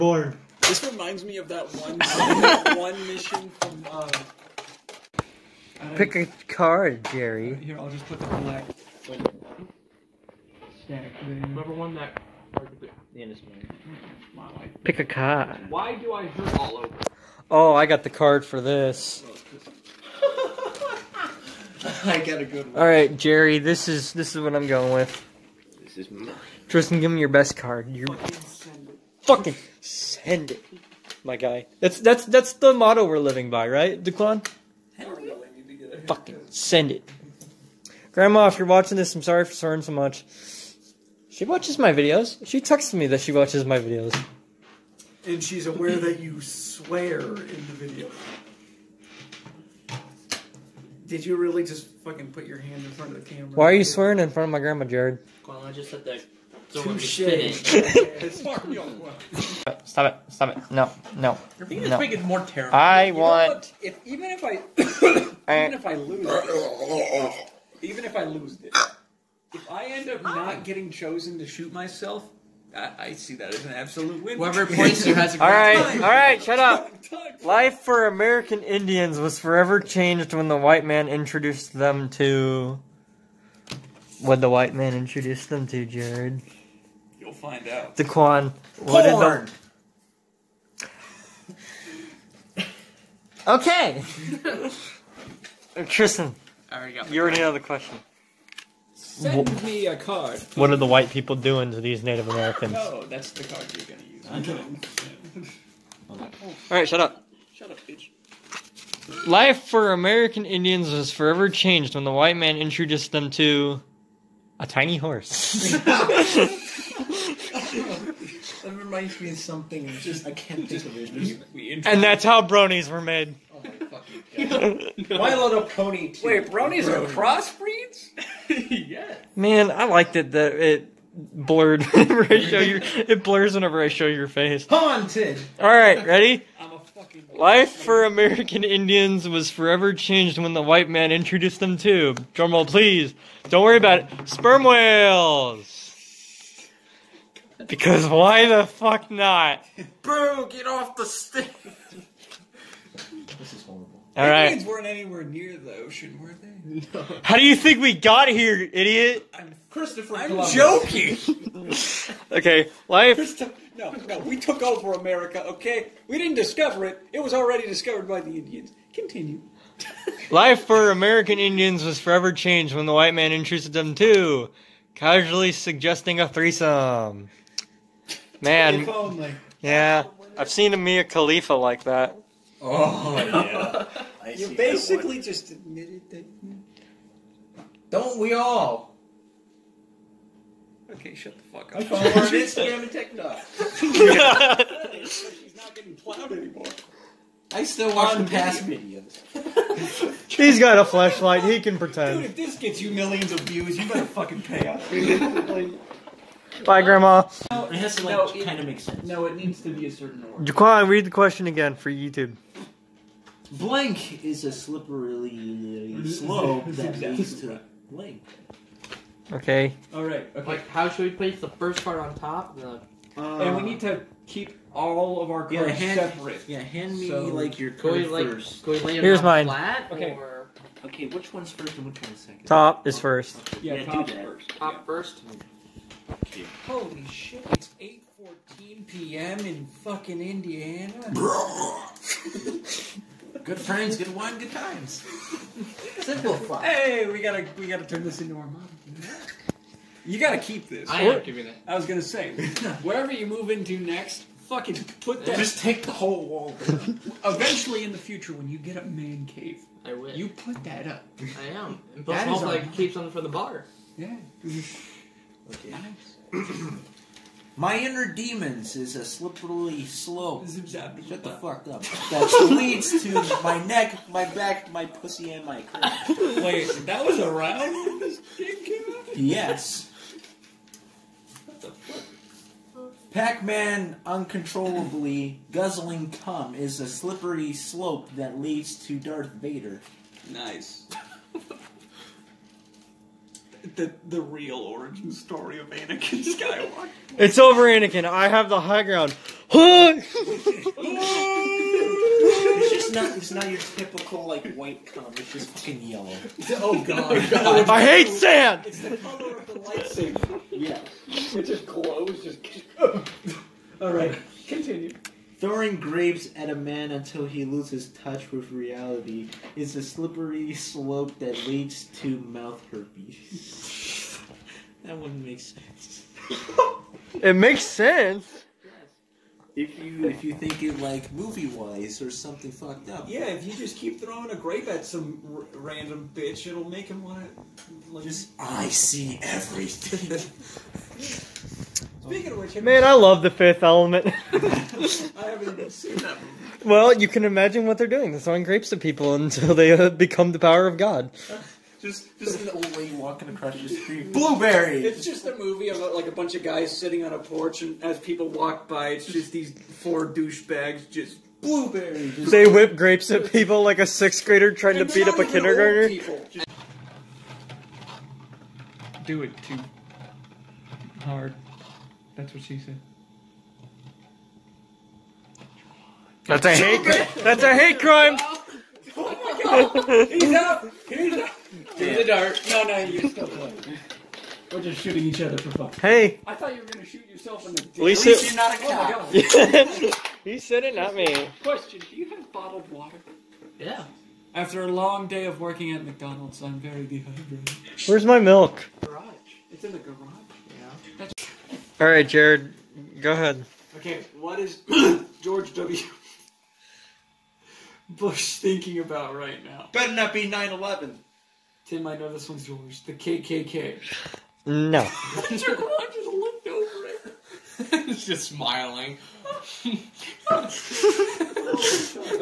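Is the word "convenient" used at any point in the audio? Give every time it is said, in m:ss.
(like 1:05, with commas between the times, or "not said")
not said.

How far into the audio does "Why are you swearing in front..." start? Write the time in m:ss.
0:53.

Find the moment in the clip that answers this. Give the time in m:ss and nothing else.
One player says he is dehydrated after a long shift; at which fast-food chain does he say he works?
6:35.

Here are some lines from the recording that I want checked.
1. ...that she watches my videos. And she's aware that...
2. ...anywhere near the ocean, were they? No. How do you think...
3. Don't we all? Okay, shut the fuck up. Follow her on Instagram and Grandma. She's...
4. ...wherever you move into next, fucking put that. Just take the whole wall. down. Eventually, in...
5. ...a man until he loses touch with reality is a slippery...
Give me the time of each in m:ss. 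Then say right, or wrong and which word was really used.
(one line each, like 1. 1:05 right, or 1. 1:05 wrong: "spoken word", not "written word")
1. 0:43 right
2. 2:34 right
3. 3:07 wrong: "TikTok", not "Grandma"
4. 4:12 right
5. 5:16 right.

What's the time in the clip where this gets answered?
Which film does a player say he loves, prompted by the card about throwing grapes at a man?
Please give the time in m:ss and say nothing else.
5:43.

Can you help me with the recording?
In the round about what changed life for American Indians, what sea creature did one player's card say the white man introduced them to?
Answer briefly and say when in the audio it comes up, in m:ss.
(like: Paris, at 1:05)
Sperm whales, at 2:24.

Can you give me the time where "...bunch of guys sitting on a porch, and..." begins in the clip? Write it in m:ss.
5:56.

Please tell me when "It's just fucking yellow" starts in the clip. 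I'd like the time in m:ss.
5:05.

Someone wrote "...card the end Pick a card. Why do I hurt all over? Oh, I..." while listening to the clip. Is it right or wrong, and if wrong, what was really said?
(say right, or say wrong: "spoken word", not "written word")
right.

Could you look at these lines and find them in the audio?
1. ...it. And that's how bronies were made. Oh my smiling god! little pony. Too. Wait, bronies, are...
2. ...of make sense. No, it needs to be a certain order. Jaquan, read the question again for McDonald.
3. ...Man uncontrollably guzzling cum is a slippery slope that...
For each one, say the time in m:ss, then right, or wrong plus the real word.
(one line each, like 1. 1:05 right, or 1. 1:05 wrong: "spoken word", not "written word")
1. 2:00 wrong: "fucking", not "smiling"
2. 3:28 wrong: "YouTube", not "McDonald"
3. 4:43 right.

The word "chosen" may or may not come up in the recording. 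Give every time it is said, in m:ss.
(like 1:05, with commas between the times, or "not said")
1:10.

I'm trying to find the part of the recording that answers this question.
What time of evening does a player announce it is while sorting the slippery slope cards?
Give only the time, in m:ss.
3:57.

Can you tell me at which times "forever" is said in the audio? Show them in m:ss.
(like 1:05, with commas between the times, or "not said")
1:19, 1:51, 2:19, 2:51.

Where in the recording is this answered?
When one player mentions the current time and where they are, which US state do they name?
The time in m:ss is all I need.
4:00.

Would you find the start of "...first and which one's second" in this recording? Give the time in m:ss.
3:51.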